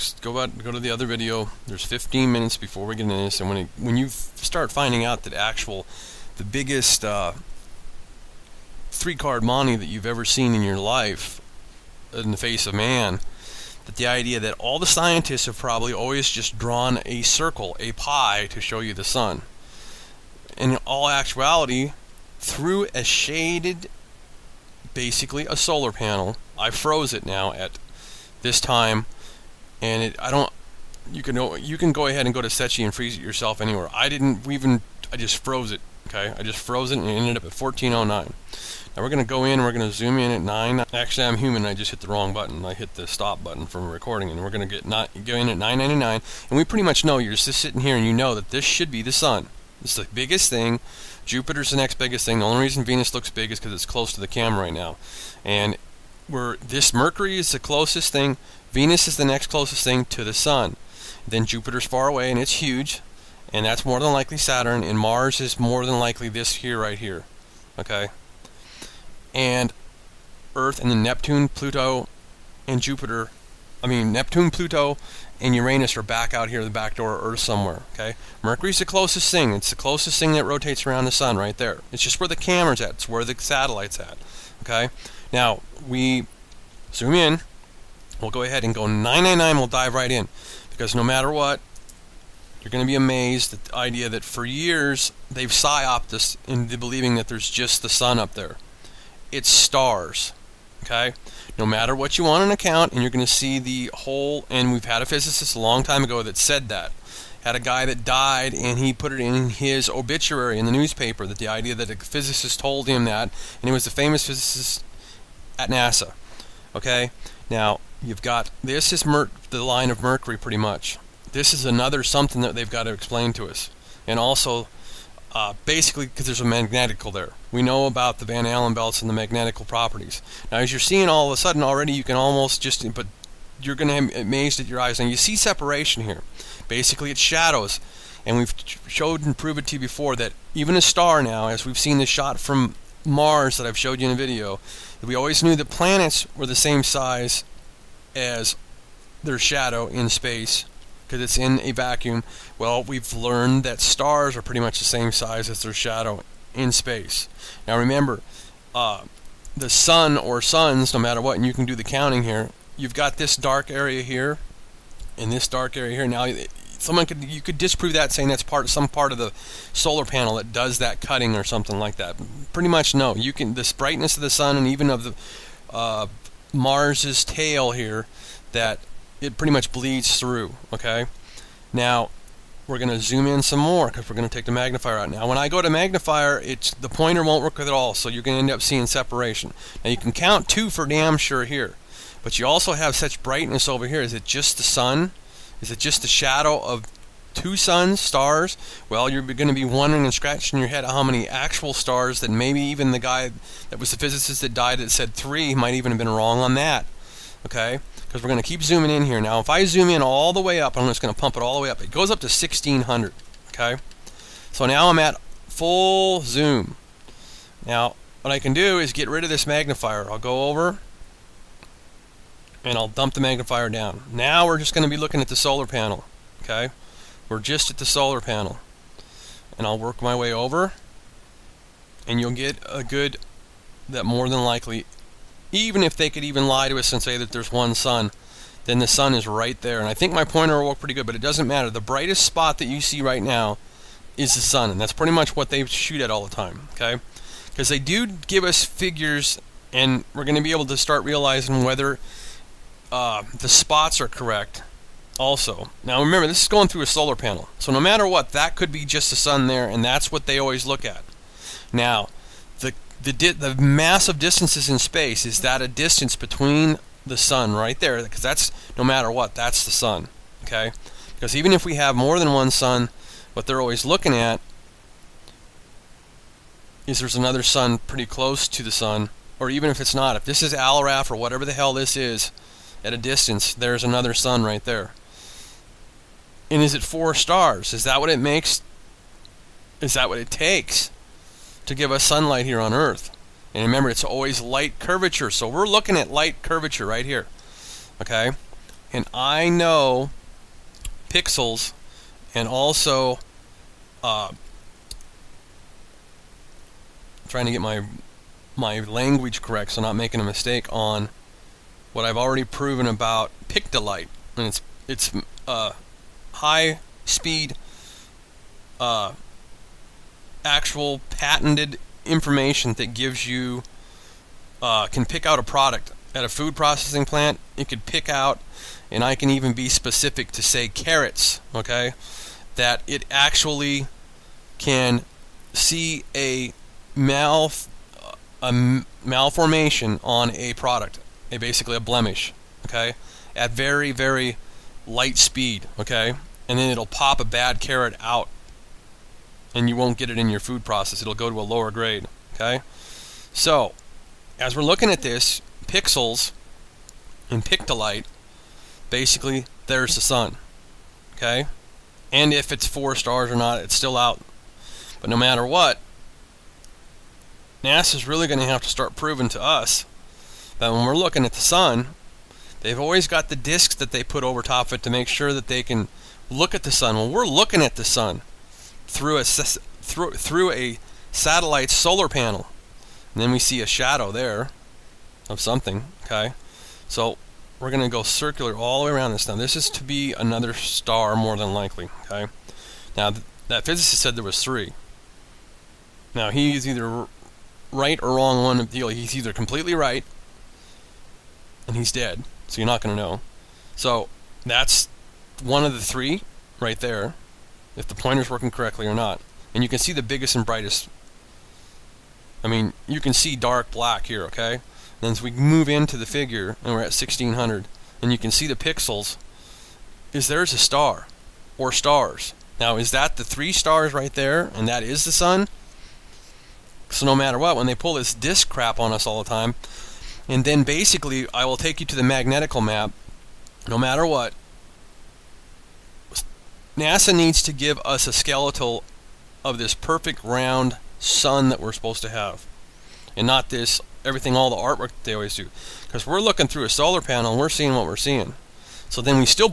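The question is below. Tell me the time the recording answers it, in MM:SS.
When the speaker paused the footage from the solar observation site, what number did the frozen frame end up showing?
00:37.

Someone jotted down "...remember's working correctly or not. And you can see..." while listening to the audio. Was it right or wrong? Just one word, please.
wrong.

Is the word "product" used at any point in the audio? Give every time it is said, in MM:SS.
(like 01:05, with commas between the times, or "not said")
05:25, 05:40.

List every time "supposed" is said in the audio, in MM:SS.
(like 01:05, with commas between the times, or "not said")
07:21.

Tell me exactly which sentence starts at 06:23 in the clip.
And then we see a shadow there of something.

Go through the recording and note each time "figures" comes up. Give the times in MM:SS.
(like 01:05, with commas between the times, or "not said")
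04:08, 06:56.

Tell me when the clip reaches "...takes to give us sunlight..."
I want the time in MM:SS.
04:50.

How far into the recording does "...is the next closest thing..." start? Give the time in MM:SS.
00:59.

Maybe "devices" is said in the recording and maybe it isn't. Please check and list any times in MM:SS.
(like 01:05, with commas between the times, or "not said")
not said.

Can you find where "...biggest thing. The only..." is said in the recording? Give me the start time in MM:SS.
00:51.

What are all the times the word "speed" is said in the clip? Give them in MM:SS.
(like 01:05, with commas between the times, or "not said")
05:17, 05:45.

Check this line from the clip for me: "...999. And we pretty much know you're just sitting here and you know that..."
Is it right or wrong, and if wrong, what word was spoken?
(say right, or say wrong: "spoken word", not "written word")
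right.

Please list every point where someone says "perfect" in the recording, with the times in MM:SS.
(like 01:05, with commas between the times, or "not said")
07:19.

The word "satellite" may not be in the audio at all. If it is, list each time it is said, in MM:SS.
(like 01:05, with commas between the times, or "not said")
01:23, 06:21.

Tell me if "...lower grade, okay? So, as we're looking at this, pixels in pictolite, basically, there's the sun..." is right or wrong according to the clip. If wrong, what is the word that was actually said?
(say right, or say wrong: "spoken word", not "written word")
right.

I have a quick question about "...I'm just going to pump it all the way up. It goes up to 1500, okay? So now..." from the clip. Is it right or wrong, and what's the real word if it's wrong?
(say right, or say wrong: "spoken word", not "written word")
wrong: "1600", not "1500".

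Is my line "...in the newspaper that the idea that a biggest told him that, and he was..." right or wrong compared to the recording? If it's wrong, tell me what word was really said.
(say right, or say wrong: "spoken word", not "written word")
wrong: "physicist", not "biggest".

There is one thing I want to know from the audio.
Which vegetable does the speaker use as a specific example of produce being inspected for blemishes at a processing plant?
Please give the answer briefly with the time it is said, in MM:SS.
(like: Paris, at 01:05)
carrots, at 05:30.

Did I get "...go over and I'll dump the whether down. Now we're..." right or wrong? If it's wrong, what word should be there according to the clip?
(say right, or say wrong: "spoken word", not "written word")
wrong: "magnifier", not "whether".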